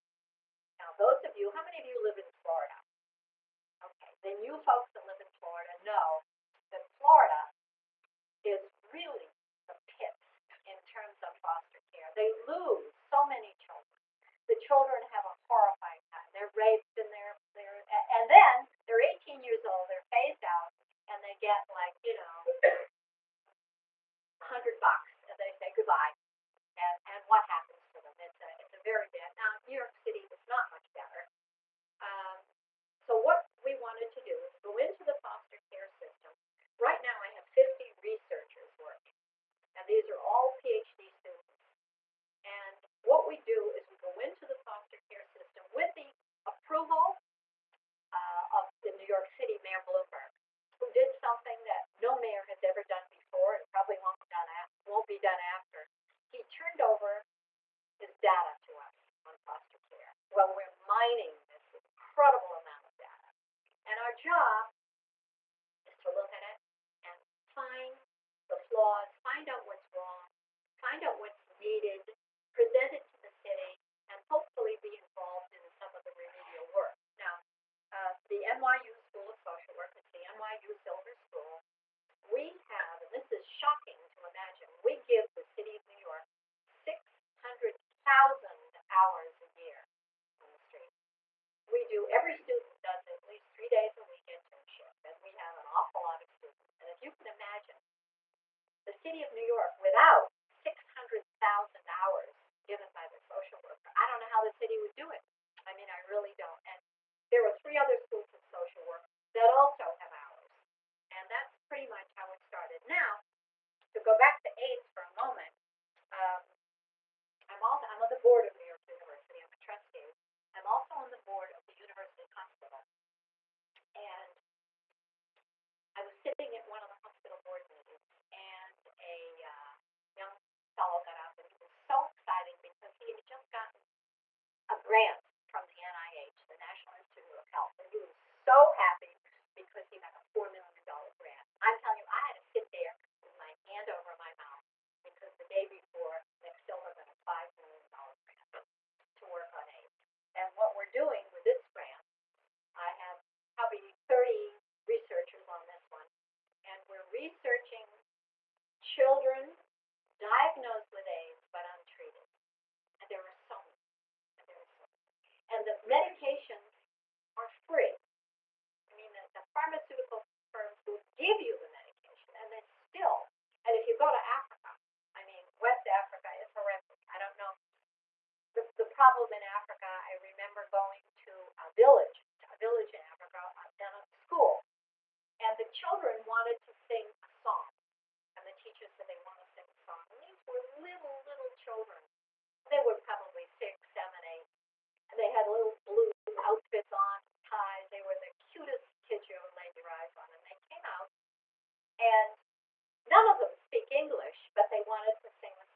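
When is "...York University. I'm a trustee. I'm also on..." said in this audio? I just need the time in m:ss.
1:58.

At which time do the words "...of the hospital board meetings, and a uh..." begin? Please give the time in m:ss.
2:06.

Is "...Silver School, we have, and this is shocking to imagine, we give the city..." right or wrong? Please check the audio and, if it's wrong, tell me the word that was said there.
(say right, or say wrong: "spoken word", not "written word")
right.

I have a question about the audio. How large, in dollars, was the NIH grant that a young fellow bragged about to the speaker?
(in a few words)
$4 million.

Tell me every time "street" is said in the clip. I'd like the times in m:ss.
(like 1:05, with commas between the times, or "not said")
1:30.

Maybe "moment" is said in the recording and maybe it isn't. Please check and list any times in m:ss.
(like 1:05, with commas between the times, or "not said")
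1:55.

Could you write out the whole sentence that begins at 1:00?
Well, we're mining this incredible amount of data.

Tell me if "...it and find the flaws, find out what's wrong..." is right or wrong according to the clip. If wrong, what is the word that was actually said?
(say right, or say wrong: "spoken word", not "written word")
right.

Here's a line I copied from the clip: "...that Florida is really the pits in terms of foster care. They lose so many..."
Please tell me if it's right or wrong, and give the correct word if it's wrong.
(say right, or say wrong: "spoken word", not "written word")
right.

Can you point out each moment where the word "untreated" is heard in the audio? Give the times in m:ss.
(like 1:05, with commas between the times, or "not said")
2:41.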